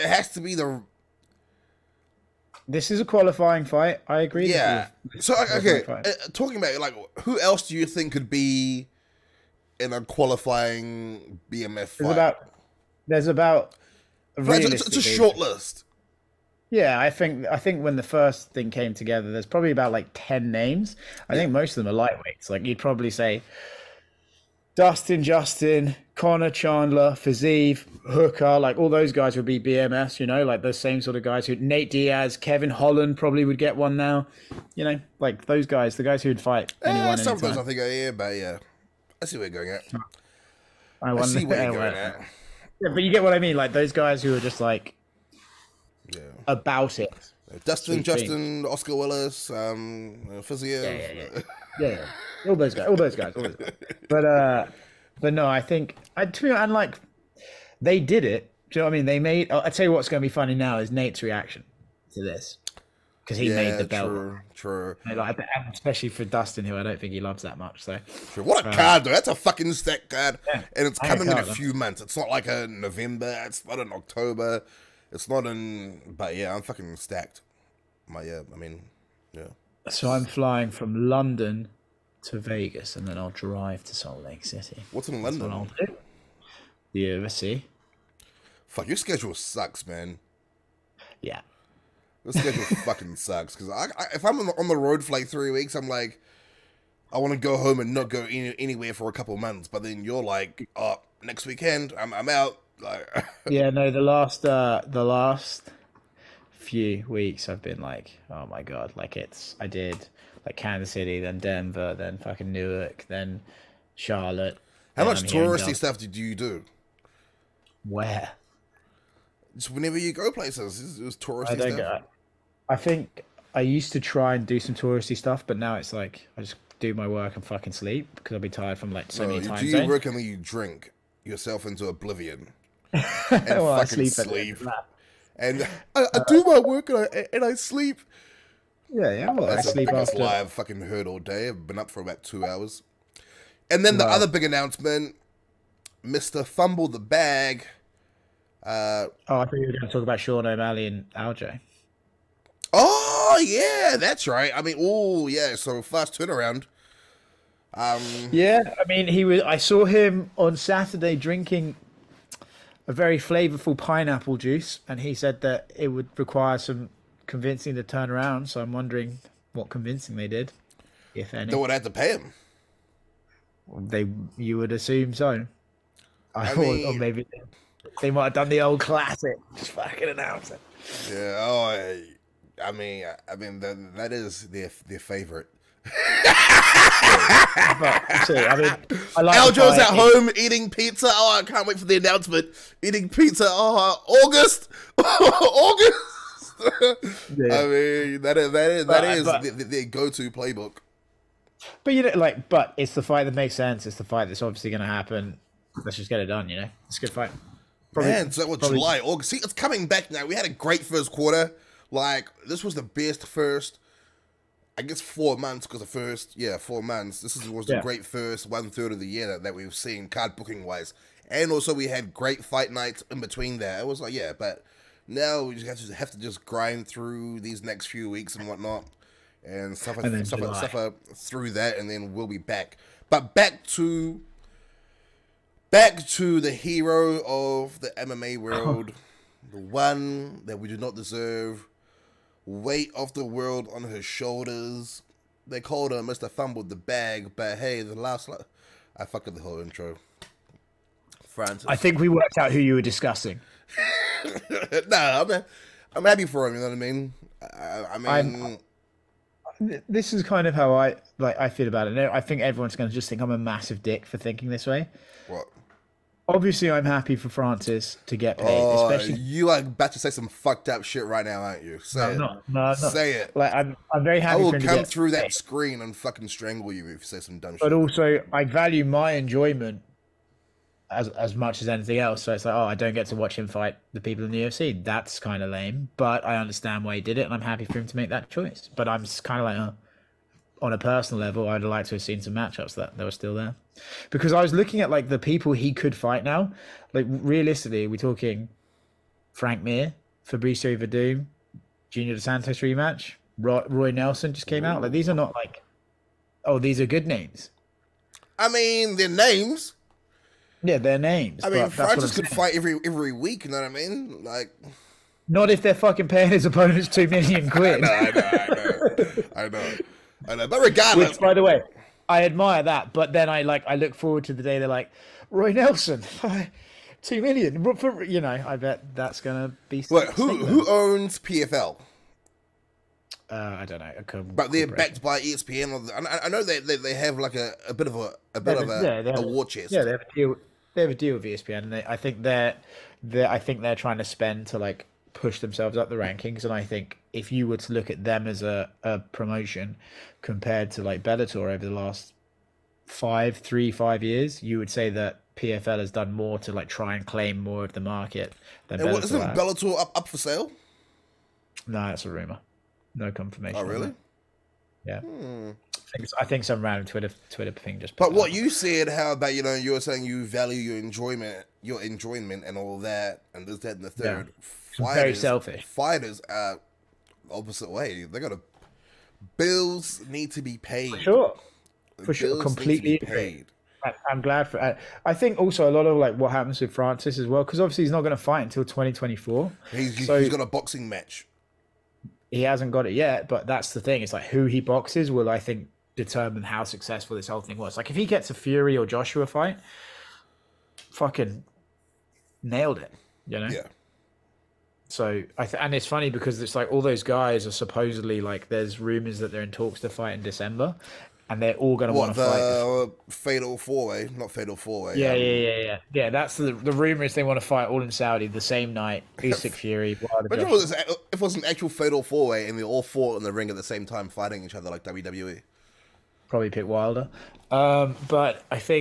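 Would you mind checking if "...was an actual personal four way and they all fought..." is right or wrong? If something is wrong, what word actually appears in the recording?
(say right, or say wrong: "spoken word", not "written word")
wrong: "fatal", not "personal".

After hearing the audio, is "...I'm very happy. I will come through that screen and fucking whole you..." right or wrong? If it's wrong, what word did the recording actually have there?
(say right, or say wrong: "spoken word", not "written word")
wrong: "strangle", not "whole".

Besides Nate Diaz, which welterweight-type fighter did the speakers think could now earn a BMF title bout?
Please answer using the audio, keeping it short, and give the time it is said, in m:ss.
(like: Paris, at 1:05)
Kevin Holland, at 0:32.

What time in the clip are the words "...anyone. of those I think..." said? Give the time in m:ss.
0:36.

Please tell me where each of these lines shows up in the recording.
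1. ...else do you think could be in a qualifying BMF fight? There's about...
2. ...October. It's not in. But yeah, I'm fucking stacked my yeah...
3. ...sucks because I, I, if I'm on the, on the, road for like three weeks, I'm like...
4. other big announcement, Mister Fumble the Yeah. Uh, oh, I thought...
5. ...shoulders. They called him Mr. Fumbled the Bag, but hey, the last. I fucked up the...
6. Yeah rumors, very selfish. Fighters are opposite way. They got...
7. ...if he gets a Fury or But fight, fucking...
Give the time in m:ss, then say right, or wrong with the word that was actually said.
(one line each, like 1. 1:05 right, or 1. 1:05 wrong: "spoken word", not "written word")
1. 0:07 right
2. 1:13 right
3. 1:33 right
4. 2:24 wrong: "Bag", not "Yeah"
5. 4:04 right
6. 6:14 wrong: "fighters", not "rumors"
7. 6:37 wrong: "Joshua", not "But".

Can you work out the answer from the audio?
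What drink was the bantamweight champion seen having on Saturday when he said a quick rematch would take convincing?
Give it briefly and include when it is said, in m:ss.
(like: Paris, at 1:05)
pineapple juice, at 2:43.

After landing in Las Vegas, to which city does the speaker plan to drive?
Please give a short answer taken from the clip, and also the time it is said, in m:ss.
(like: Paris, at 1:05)
Salt Lake City, at 1:23.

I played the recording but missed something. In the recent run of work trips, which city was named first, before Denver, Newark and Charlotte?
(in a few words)
Kansas City.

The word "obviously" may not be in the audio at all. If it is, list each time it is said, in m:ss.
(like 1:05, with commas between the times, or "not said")
3:24, 4:26, 6:27.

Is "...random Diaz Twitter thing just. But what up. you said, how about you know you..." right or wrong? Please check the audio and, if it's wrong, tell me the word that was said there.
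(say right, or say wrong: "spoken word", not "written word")
wrong: "Twitter", not "Diaz".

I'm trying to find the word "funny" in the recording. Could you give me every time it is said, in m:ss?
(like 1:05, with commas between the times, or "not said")
1:00, 6:45.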